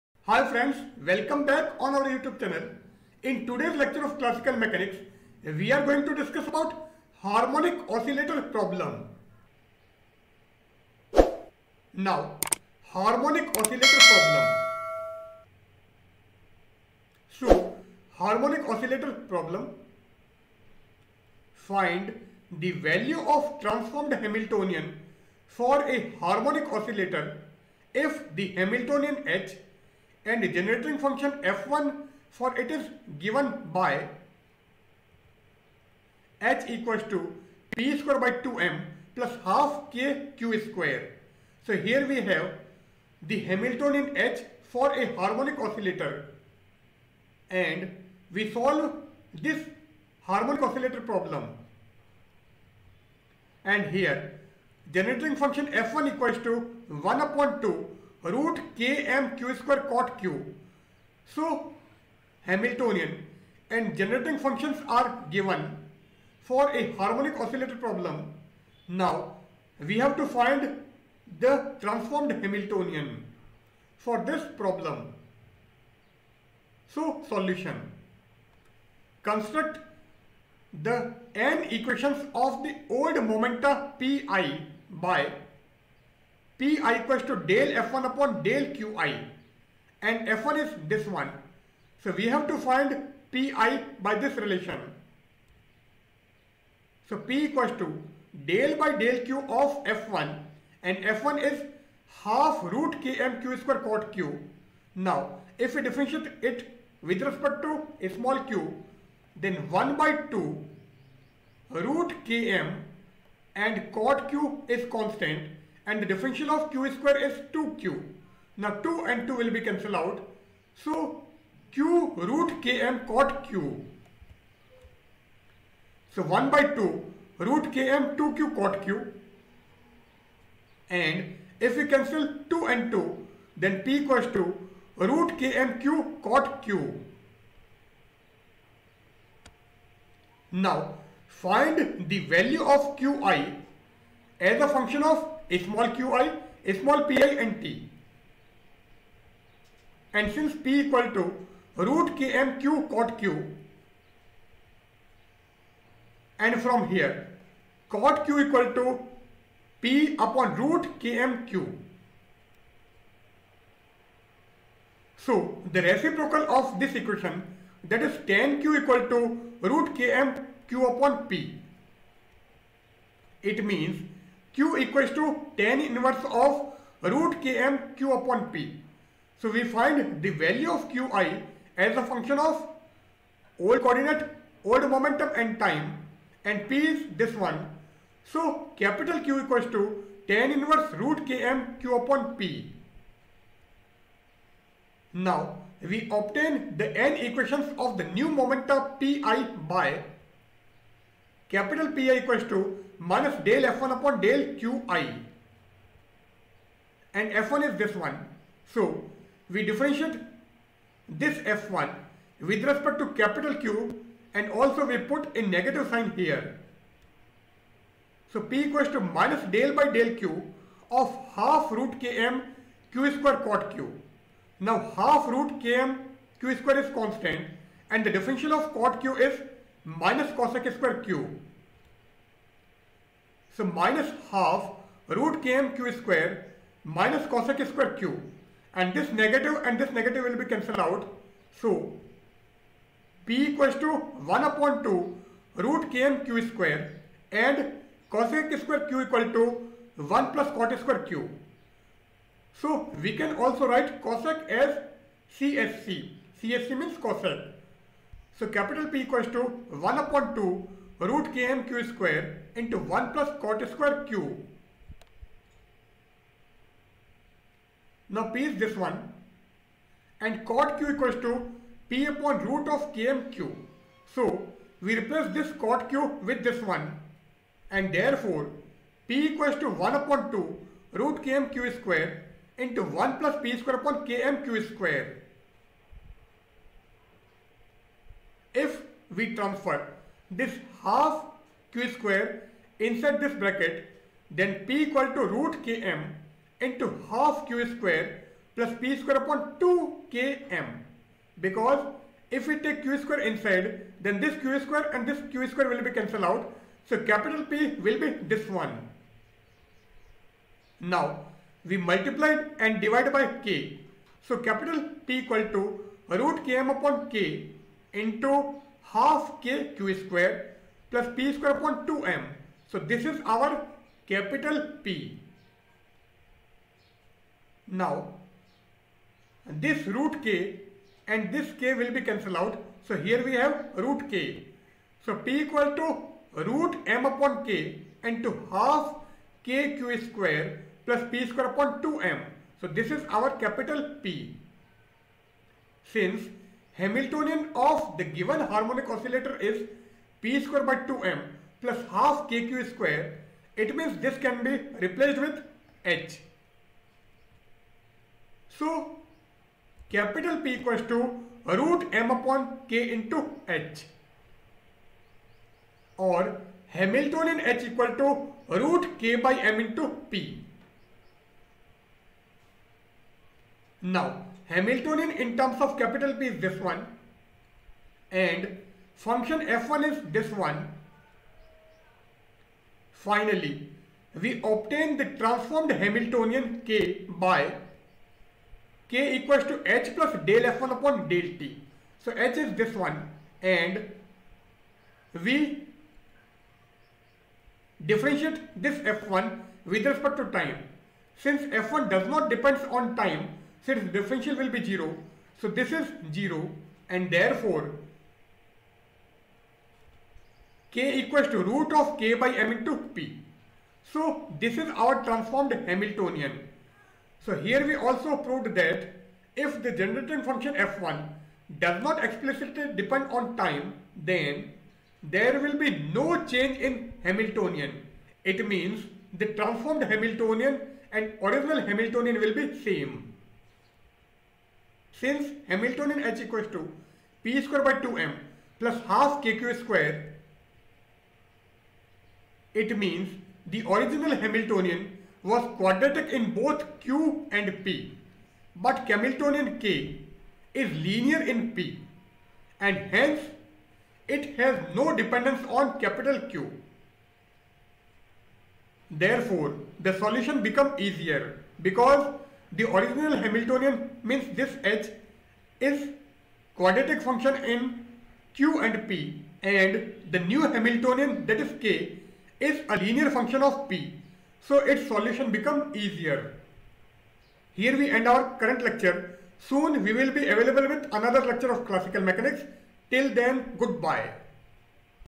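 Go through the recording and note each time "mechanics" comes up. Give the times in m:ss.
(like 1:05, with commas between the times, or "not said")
0:04, 8:02.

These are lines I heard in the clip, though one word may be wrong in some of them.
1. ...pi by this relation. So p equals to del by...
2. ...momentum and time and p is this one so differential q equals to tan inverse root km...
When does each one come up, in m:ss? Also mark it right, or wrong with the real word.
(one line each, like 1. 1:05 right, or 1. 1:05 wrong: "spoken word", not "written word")
1. 1:33 right
2. 3:04 wrong: "capital", not "differential".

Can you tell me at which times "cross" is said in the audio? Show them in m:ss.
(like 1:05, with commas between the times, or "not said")
not said.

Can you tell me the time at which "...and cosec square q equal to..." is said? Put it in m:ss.
4:07.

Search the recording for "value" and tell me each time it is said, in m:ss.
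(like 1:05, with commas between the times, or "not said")
0:22, 2:22, 3:00.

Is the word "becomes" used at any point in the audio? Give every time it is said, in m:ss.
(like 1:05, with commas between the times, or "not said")
7:40, 7:55.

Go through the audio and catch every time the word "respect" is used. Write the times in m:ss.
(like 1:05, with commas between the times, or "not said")
1:47, 3:32, 6:39.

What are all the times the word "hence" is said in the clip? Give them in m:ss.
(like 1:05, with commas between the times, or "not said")
7:32.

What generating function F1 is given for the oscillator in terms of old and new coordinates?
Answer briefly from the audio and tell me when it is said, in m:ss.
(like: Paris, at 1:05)
1/(2√km) q² cot Q, at 0:56.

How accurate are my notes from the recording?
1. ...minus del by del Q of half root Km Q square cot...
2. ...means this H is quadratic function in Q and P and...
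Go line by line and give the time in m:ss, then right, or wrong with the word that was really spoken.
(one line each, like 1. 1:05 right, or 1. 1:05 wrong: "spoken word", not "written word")
1. 3:38 right
2. 7:44 right.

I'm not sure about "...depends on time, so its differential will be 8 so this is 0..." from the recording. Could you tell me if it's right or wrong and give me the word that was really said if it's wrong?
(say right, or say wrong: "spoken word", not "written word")
wrong: "0", not "8".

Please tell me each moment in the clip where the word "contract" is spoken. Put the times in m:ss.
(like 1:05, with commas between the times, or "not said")
not said.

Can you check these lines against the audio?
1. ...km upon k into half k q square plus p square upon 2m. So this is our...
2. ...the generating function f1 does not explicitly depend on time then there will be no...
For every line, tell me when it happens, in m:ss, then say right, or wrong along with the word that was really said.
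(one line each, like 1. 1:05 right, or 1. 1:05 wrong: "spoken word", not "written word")
1. 5:16 right
2. 6:59 right.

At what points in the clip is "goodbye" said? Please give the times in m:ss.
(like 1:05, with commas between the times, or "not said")
8:03.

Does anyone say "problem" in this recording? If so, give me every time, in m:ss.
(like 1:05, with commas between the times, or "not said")
0:08, 0:14, 0:19, 0:51, 1:07, 1:14.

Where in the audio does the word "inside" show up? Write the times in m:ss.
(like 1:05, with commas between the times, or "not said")
4:52, 5:03.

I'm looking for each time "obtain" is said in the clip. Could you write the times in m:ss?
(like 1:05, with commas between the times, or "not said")
3:16, 6:24.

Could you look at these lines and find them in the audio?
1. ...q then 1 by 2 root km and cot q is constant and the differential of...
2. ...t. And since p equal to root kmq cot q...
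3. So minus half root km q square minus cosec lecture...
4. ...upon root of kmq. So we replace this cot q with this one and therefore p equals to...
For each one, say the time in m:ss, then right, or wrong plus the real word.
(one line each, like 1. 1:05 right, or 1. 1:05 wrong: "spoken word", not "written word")
1. 1:48 right
2. 2:27 right
3. 3:53 wrong: "square", not "lecture"
4. 4:32 right.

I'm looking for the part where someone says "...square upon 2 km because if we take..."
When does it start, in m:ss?
4:58.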